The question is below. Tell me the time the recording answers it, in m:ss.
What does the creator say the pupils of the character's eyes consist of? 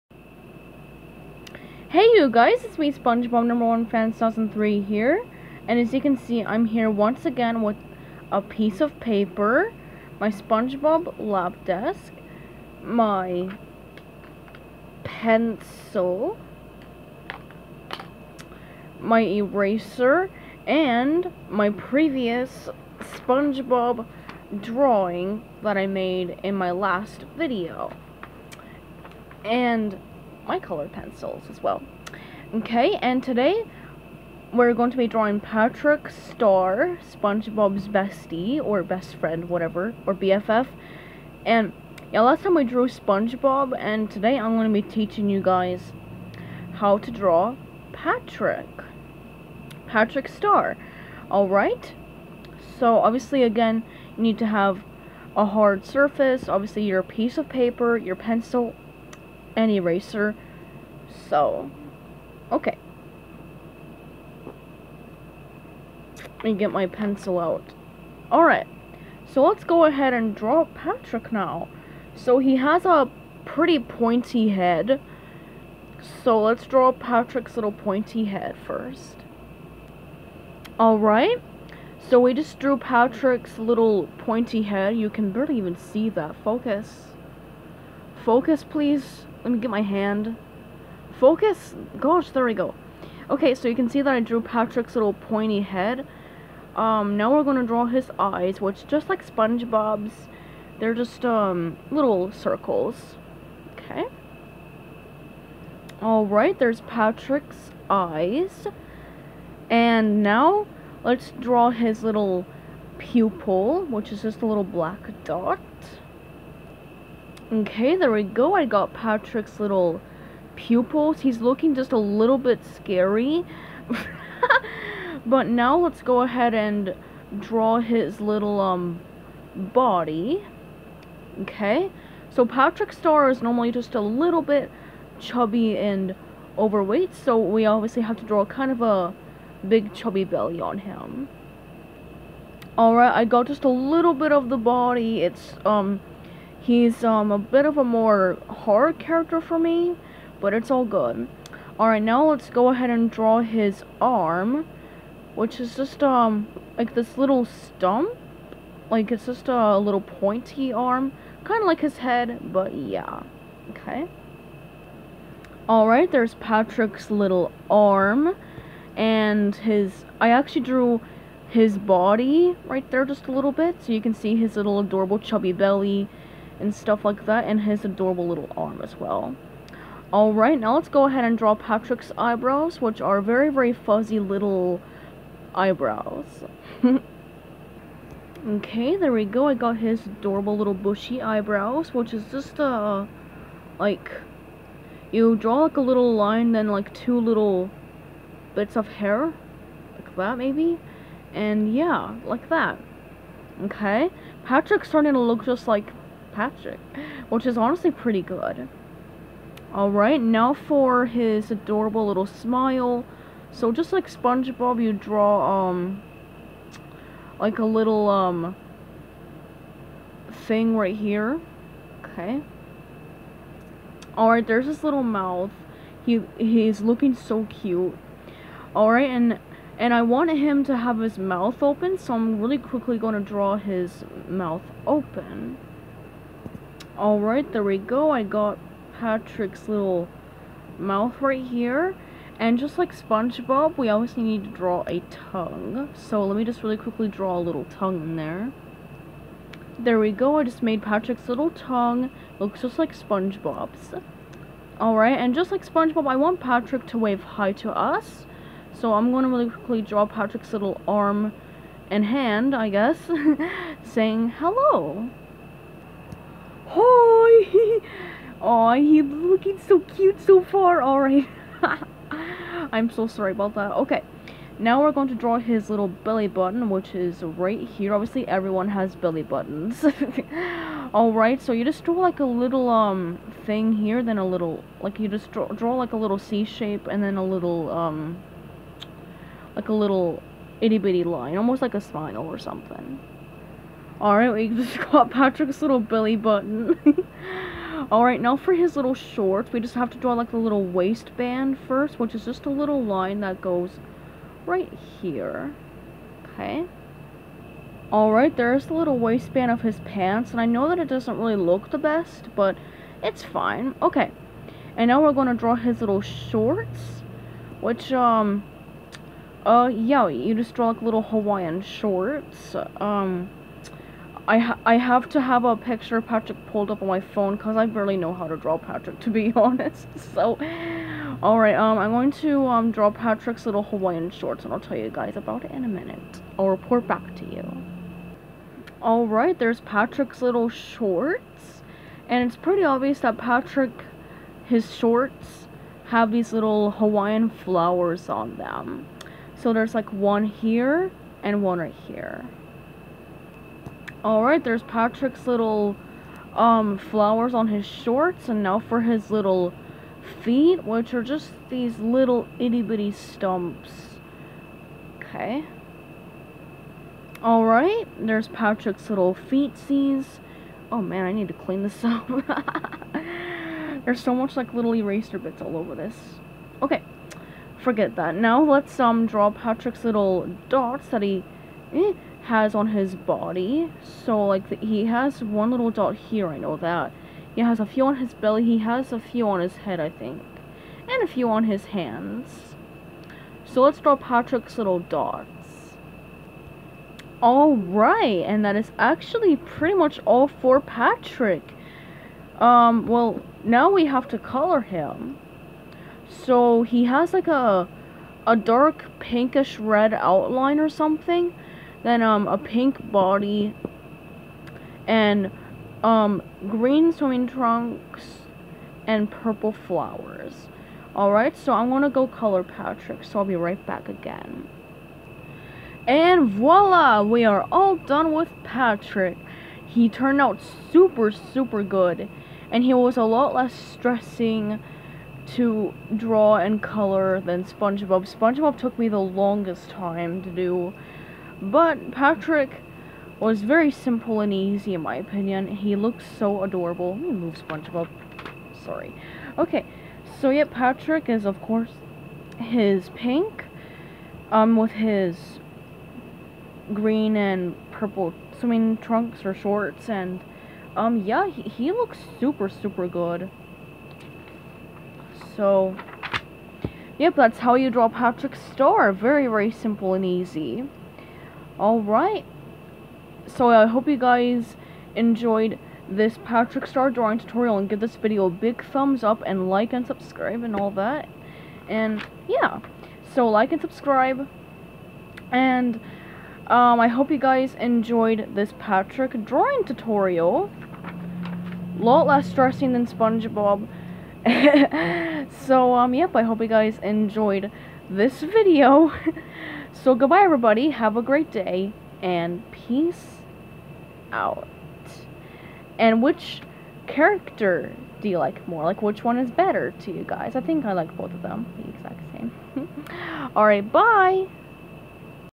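1:54.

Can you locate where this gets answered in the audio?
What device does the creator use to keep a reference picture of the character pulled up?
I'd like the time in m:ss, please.
5:26.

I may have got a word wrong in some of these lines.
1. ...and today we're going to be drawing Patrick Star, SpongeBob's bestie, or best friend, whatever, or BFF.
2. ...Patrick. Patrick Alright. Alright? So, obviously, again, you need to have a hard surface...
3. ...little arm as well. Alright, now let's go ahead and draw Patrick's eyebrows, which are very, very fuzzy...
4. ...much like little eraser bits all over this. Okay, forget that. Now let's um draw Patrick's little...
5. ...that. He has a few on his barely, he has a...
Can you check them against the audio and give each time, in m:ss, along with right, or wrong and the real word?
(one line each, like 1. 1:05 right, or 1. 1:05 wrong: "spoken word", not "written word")
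1. 0:33 right
2. 0:47 wrong: "Star", not "Alright"
3. 2:58 right
4. 6:14 right
5. 6:26 wrong: "belly", not "barely".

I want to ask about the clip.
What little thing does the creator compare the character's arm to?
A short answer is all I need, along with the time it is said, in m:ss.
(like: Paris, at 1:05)
stump, at 2:37.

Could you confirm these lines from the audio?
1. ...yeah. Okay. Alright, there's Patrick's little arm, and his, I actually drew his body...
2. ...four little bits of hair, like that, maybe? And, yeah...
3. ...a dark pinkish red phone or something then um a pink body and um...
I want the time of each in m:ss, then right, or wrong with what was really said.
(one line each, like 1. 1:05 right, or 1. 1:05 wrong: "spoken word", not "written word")
1. 2:42 right
2. 3:16 wrong: "two", not "four"
3. 6:48 wrong: "outline", not "phone".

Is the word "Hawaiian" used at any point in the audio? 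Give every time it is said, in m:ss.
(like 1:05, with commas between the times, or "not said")
5:21, 5:33, 5:46.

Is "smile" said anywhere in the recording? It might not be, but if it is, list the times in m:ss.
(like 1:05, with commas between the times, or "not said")
3:32, 4:51.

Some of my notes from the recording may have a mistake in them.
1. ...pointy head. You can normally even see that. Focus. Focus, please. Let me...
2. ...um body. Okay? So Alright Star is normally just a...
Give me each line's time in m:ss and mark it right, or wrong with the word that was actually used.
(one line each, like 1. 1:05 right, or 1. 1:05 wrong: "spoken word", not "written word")
1. 1:24 wrong: "barely", not "normally"
2. 2:08 wrong: "Patrick", not "Alright".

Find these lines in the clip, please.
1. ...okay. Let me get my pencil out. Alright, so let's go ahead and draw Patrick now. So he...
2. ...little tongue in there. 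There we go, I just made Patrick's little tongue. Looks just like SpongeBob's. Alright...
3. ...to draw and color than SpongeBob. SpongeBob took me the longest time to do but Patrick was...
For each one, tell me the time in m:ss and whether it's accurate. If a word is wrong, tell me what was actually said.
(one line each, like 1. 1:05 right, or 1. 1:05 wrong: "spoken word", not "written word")
1. 1:02 right
2. 4:07 right
3. 7:15 right.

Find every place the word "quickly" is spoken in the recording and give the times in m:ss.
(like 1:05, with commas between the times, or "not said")
3:52, 4:06, 4:19.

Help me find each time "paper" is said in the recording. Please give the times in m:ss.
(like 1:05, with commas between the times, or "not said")
0:09, 0:57.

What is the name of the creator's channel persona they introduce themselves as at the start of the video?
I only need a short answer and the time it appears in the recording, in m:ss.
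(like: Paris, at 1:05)
SpongeBob number one fan 2003, at 0:02.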